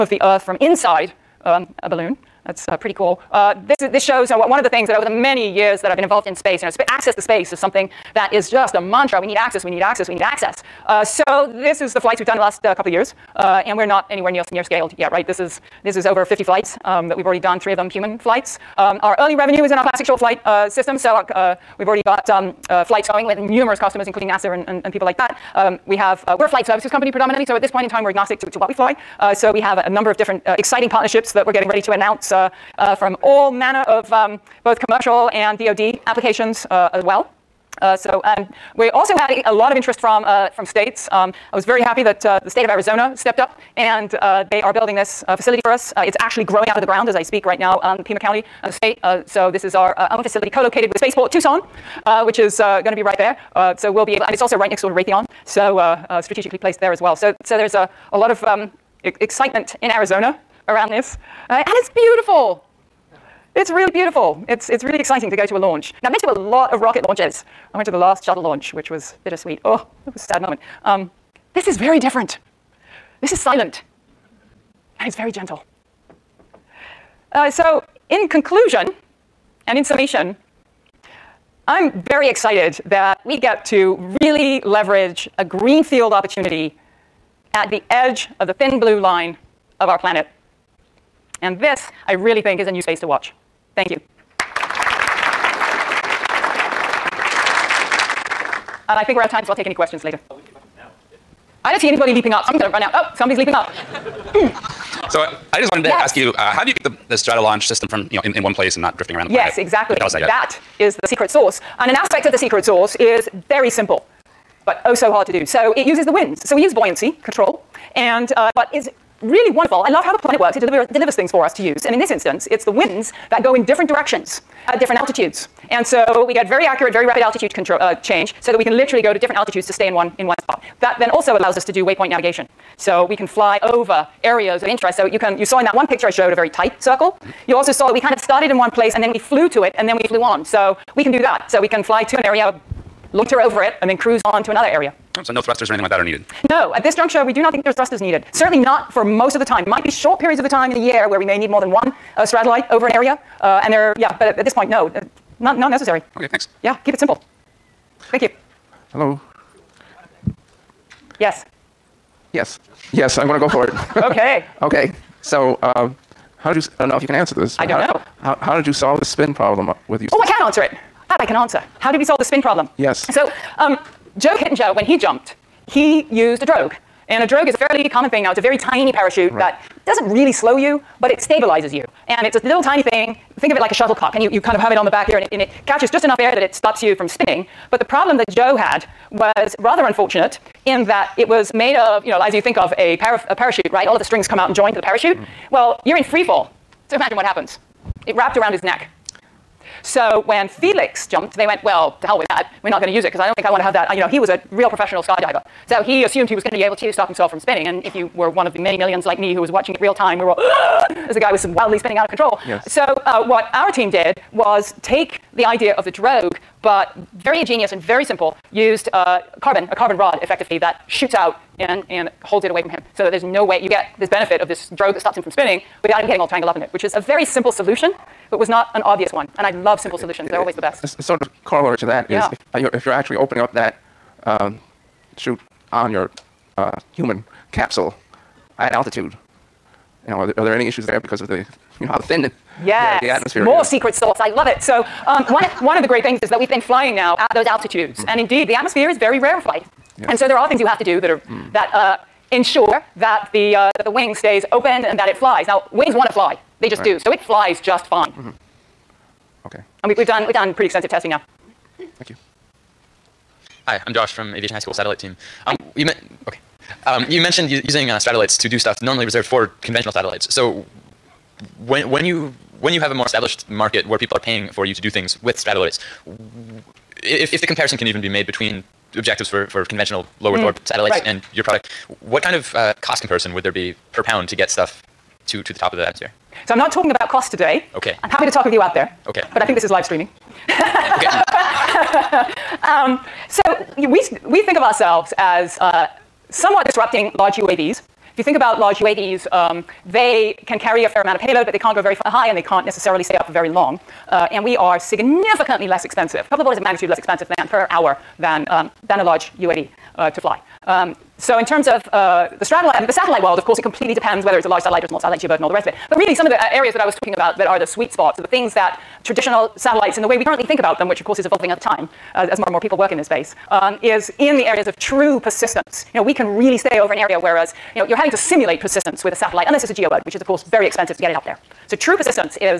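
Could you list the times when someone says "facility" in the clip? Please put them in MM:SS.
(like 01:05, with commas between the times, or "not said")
00:45, 00:50.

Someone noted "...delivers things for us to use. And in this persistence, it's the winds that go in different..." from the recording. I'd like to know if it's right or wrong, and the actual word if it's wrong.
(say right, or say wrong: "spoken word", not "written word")
wrong: "instance", not "persistence".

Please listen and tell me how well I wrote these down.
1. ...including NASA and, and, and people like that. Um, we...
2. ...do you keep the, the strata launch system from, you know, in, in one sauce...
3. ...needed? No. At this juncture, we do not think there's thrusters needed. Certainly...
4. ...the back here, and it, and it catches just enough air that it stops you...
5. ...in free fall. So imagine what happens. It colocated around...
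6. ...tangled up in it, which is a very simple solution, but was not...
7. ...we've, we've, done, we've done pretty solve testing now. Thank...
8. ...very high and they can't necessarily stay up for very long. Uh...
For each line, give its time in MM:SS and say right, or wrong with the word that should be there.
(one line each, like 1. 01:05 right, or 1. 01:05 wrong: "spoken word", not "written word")
1. 00:24 right
2. 01:46 wrong: "place", not "sauce"
3. 02:26 right
4. 03:04 right
5. 03:15 wrong: "wrapped", not "colocated"
6. 03:46 right
7. 04:19 wrong: "extensive", not "solve"
8. 05:01 right.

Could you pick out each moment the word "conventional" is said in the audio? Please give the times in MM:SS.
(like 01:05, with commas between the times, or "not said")
04:29, 04:39.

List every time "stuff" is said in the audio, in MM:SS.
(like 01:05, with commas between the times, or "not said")
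04:28, 04:44.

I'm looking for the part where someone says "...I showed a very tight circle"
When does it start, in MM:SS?
02:16.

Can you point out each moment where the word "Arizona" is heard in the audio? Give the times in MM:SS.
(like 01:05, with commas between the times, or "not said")
00:42, 00:59.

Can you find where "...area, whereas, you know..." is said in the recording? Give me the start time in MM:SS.
05:26.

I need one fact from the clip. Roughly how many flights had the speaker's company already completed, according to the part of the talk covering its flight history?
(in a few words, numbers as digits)
over 50.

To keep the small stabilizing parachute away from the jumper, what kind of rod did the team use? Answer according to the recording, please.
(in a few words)
carbon rod.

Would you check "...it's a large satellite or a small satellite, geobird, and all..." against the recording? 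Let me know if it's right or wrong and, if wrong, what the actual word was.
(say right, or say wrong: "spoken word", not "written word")
right.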